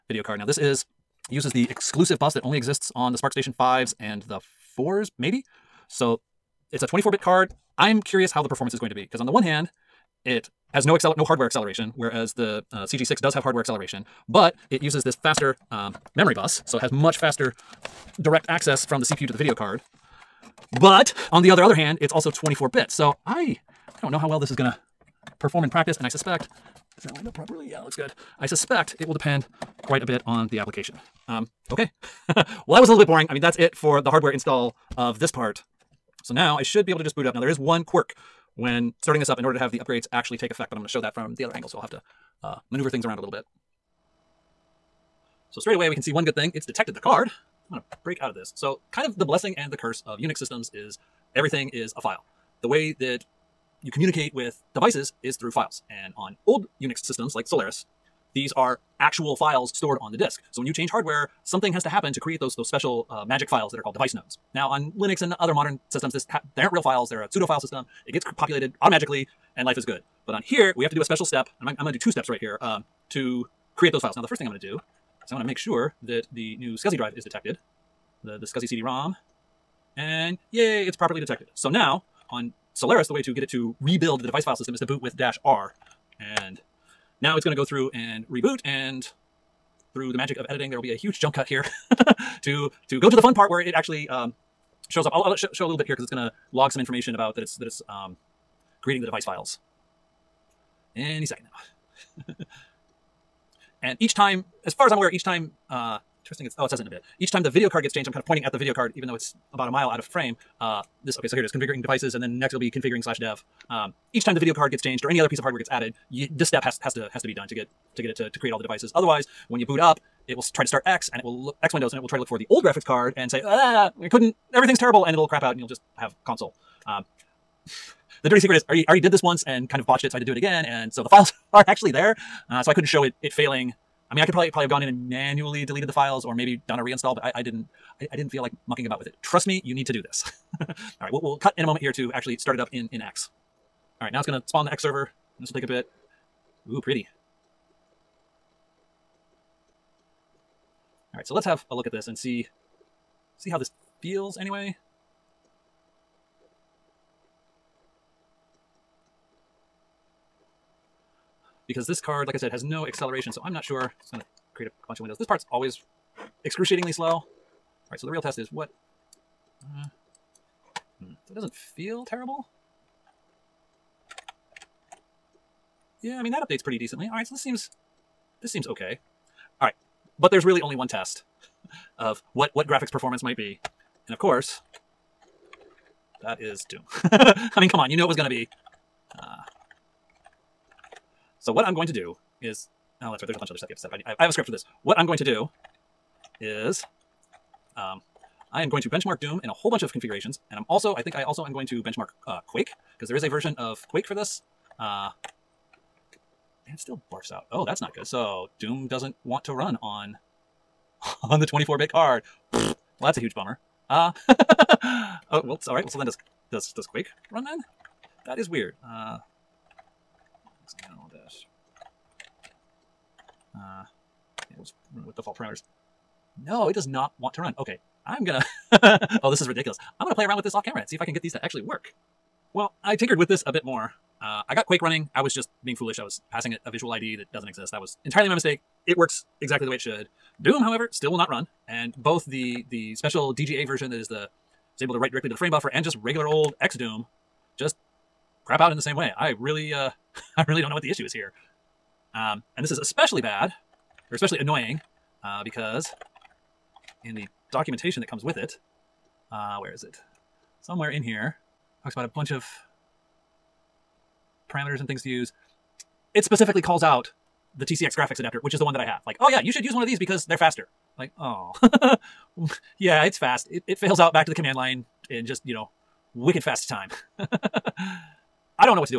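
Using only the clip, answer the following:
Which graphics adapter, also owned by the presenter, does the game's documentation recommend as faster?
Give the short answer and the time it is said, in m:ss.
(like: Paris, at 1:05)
TCX, at 4:27.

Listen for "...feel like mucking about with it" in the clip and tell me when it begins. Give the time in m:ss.
2:18.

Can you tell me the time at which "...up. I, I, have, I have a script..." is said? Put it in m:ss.
3:13.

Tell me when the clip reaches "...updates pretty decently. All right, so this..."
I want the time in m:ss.
2:56.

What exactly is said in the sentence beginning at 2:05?
And it'll crap out and you'll just have console.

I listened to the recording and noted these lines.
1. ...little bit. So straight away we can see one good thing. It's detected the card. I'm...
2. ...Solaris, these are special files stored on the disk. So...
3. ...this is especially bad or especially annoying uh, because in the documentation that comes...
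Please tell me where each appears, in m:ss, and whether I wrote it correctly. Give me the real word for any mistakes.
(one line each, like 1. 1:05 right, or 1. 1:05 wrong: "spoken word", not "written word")
1. 0:43 right
2. 0:57 wrong: "actual", not "special"
3. 4:12 right.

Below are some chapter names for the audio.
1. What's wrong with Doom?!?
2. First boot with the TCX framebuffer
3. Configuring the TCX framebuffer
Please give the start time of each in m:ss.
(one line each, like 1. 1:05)
1. 2:59
2. 2:23
3. 0:45.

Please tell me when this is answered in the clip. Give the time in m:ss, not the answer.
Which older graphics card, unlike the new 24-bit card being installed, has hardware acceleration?
0:12.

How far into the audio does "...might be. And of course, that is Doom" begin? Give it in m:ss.
3:03.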